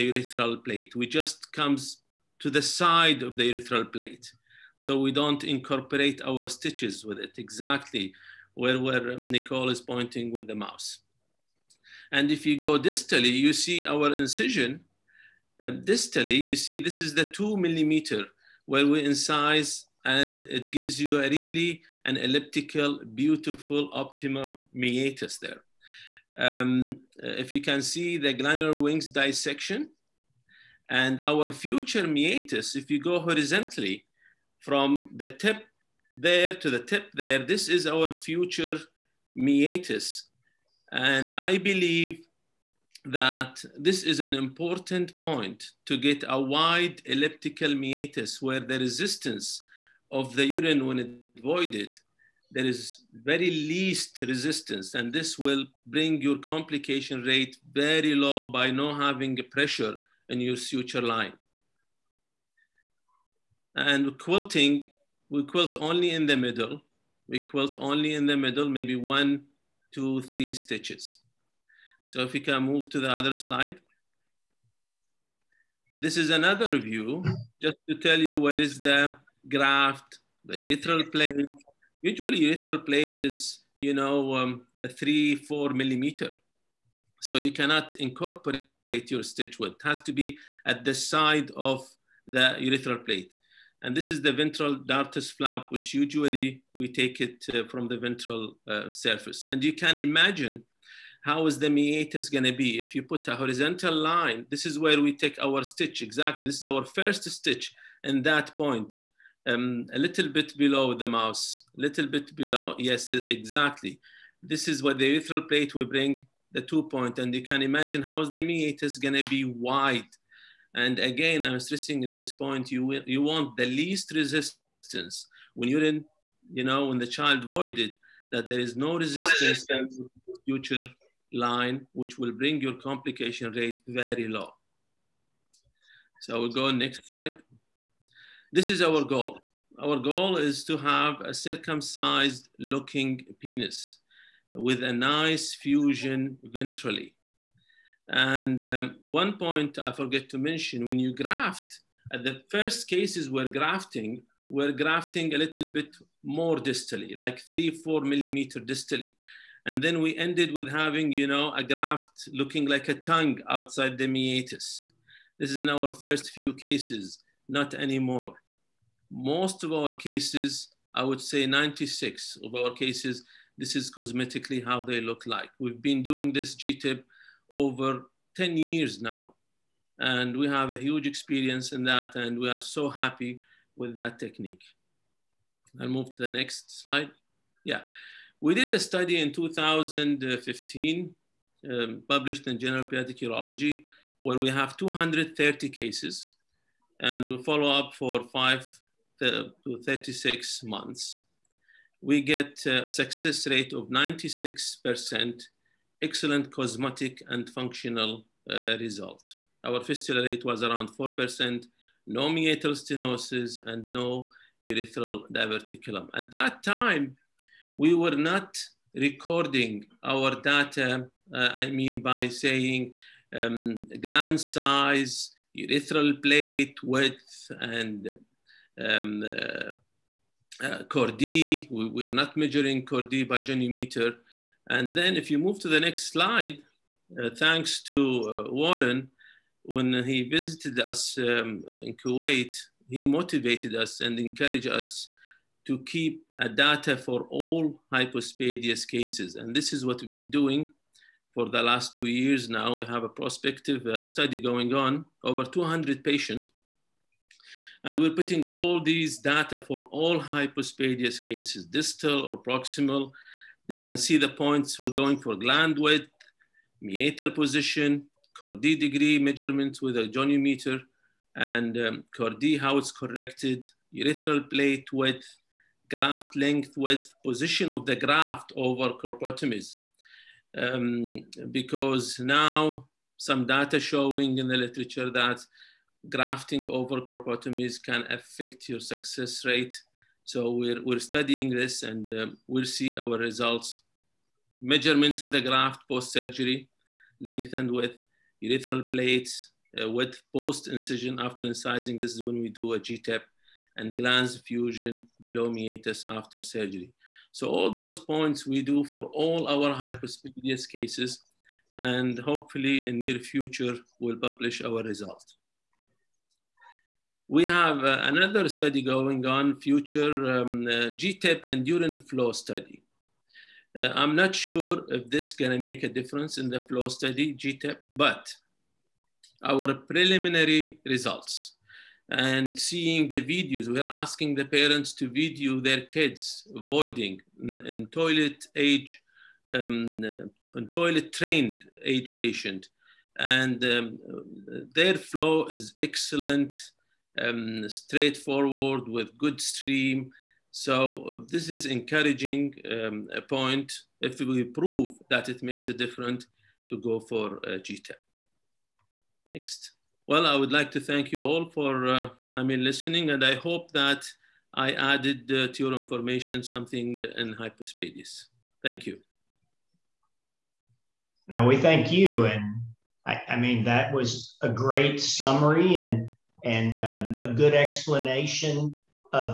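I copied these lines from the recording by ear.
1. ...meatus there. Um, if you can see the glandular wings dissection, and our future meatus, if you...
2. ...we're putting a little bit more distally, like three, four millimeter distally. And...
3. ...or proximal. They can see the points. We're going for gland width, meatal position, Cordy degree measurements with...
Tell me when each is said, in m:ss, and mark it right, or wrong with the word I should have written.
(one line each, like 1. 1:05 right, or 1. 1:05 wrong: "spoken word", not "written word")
1. 0:24 right
2. 2:34 wrong: "grafting", not "putting"
3. 4:22 right.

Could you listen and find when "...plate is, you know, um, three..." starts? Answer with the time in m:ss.
1:22.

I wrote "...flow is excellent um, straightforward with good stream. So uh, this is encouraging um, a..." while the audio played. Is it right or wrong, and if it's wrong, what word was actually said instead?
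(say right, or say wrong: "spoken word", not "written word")
right.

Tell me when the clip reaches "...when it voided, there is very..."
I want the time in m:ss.
0:50.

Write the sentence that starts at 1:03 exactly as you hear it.
And quilting, we quilt only in the middle.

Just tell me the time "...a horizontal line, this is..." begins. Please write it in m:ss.
1:43.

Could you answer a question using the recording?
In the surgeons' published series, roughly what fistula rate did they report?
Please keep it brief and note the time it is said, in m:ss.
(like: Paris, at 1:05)
4%, at 3:30.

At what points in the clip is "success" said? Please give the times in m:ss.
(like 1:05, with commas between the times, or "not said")
3:22, 4:48.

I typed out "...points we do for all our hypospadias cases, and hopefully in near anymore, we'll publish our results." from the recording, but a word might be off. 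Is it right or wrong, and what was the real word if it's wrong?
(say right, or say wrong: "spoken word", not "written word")
wrong: "future", not "anymore".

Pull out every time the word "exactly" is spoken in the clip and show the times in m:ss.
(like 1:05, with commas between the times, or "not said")
0:07, 1:46, 1:53.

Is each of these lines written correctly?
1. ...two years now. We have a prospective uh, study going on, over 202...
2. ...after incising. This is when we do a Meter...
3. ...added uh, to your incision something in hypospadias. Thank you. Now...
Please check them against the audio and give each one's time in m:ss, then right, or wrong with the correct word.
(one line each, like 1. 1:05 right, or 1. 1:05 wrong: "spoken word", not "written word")
1. 4:11 wrong: "200", not "202"
2. 5:01 wrong: "GTIP", not "Meter"
3. 6:04 wrong: "information", not "incision".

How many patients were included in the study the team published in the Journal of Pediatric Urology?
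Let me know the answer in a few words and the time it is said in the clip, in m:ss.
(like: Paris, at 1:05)
230, at 3:14.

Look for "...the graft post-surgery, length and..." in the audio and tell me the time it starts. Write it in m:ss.
4:55.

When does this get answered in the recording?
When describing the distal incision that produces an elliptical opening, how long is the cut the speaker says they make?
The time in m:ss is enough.
0:17.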